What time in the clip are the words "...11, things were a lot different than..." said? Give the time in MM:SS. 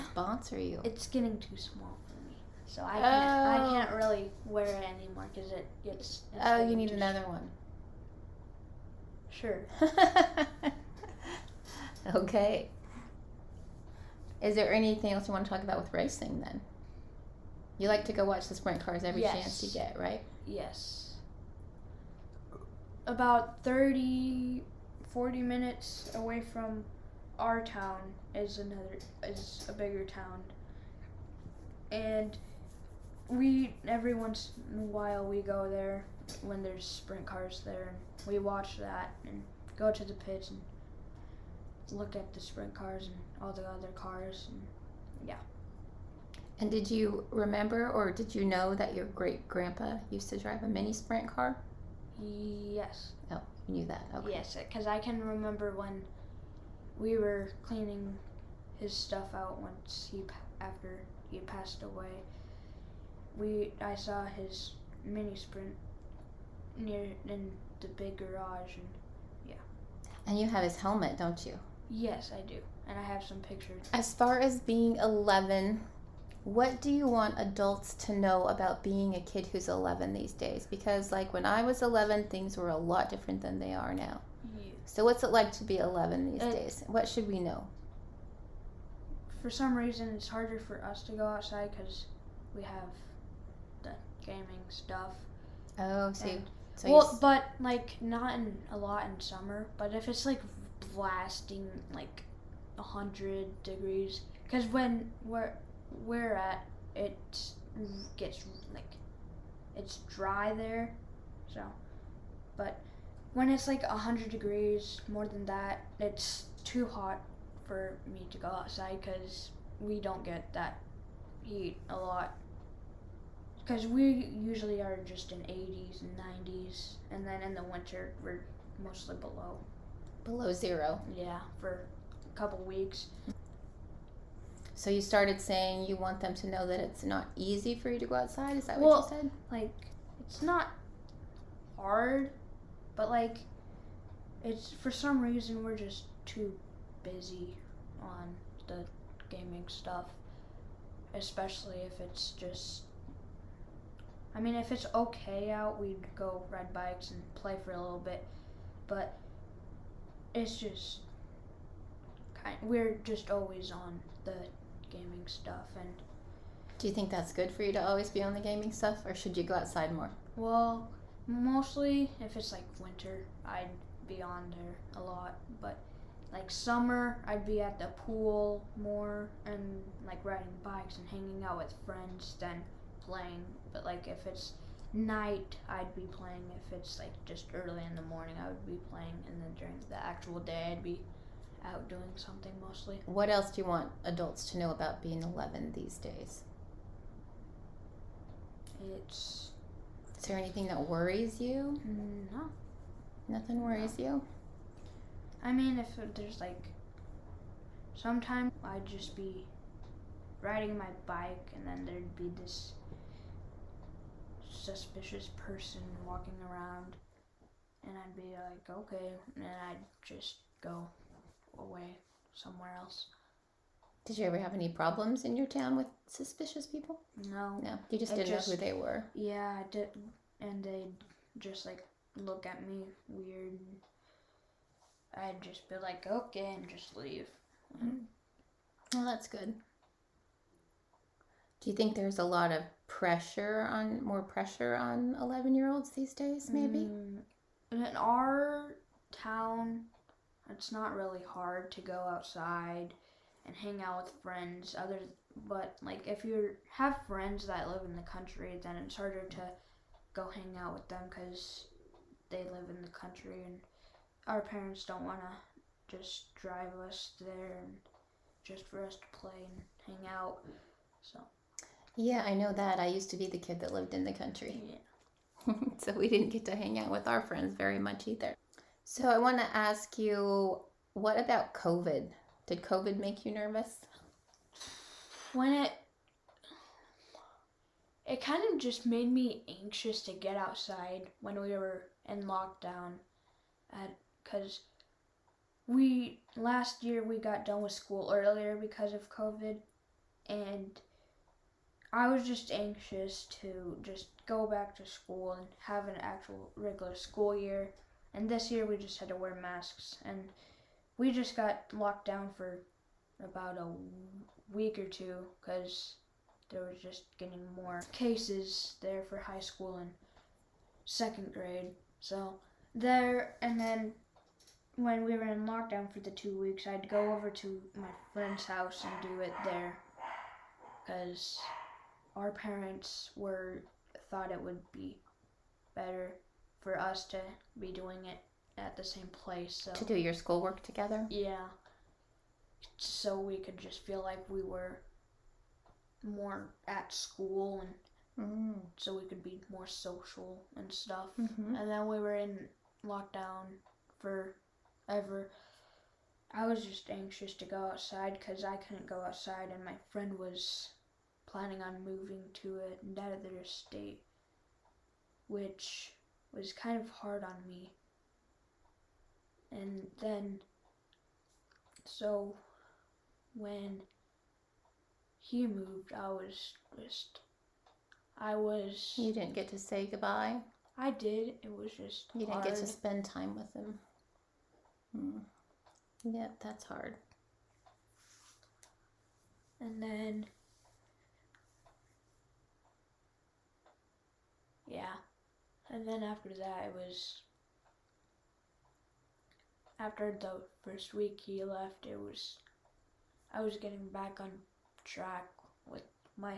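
01:21.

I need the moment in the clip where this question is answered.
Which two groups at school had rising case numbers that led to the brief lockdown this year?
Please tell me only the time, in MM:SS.
05:19.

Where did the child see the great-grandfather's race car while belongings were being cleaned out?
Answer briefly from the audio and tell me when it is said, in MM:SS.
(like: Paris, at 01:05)
The big garage, at 01:07.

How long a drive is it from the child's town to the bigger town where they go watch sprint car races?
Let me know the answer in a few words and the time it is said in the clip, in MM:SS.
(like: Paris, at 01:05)
30 to 40 minutes, at 00:23.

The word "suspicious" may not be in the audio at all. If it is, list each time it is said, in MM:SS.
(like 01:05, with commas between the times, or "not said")
03:34, 03:46.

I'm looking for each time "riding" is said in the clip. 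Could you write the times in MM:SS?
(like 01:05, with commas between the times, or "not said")
03:00, 03:30.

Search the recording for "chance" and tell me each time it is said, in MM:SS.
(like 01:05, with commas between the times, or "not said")
00:19.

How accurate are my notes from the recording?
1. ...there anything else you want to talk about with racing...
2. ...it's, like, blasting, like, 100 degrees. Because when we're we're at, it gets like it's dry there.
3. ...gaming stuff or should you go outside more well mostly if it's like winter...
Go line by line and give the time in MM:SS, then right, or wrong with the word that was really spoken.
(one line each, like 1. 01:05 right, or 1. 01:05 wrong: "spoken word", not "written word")
1. 00:14 right
2. 01:40 right
3. 02:48 right.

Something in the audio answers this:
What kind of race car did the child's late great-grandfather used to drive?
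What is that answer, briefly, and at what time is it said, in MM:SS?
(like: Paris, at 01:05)
Mini sprint car, at 00:50.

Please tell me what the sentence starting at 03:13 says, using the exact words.
What else do you want adults to know about being 11 these days?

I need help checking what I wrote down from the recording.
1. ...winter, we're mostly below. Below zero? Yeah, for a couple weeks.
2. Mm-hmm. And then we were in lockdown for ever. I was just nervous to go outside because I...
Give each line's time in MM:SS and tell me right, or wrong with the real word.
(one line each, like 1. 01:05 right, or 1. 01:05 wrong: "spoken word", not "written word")
1. 02:07 right
2. 05:51 wrong: "anxious", not "nervous".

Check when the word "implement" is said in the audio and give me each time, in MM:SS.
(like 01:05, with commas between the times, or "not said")
not said.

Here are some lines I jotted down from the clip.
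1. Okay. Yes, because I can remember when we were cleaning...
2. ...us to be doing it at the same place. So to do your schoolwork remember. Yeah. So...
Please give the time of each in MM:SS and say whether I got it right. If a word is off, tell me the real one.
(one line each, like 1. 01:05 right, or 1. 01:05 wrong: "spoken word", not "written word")
1. 00:54 right
2. 05:36 wrong: "together", not "remember".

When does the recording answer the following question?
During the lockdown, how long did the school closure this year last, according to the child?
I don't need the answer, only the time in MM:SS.
05:13.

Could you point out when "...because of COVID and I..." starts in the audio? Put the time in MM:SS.
04:58.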